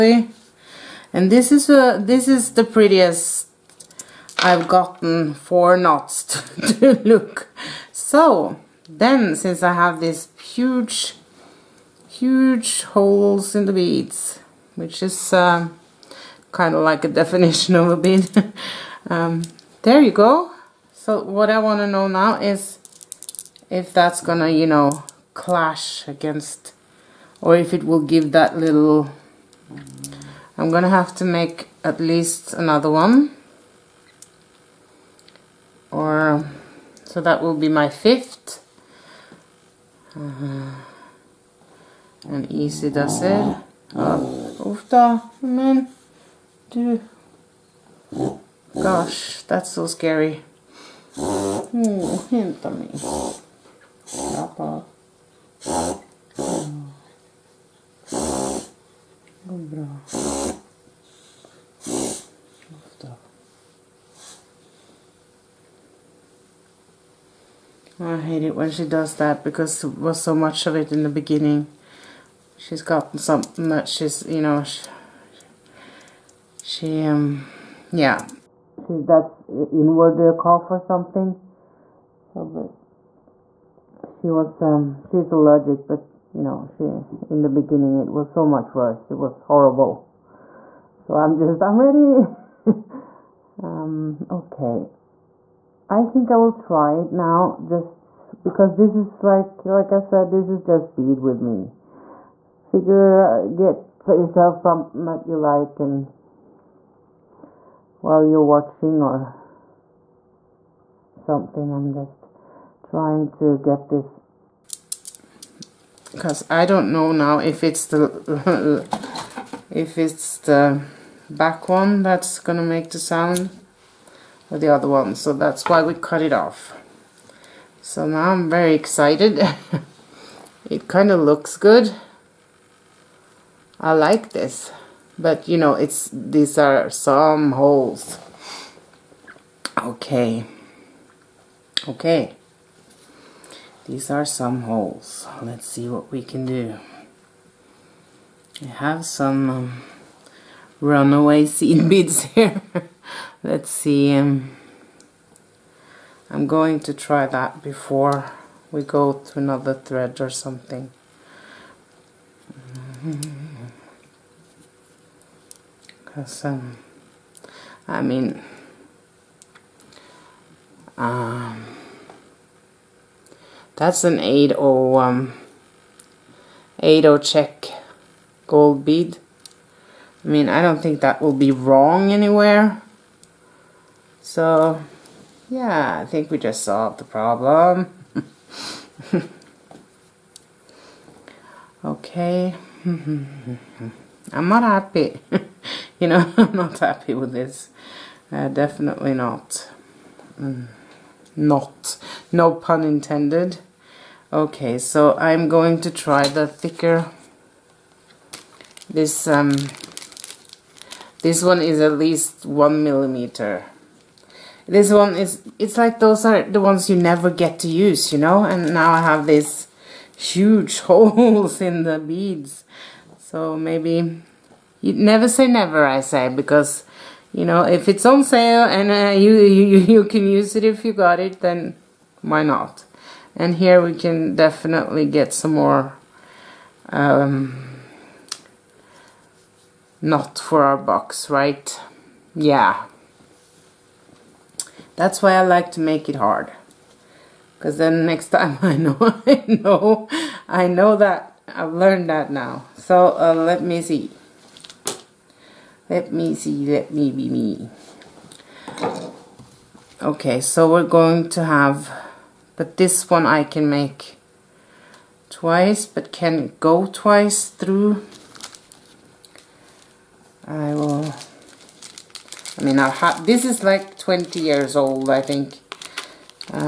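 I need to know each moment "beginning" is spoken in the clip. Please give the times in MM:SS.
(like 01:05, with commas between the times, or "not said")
01:11, 01:27.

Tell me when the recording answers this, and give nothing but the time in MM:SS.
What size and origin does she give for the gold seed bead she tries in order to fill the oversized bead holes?
02:56.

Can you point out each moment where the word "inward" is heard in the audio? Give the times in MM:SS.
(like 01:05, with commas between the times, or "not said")
01:19.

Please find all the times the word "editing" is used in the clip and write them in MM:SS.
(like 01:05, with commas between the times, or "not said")
not said.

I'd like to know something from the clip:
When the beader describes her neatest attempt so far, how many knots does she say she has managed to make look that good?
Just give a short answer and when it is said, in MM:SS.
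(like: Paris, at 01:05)
4, at 00:05.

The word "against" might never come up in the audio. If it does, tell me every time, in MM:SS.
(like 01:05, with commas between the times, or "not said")
00:26.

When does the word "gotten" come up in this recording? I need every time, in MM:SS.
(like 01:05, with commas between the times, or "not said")
00:04, 01:12.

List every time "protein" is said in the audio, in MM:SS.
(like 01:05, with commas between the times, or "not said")
not said.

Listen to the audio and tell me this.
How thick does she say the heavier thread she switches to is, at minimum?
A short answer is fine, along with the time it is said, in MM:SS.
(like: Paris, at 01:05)
one millimeter, at 03:32.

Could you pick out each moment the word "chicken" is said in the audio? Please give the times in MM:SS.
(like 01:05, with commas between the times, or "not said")
not said.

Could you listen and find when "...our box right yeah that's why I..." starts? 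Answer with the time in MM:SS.
04:00.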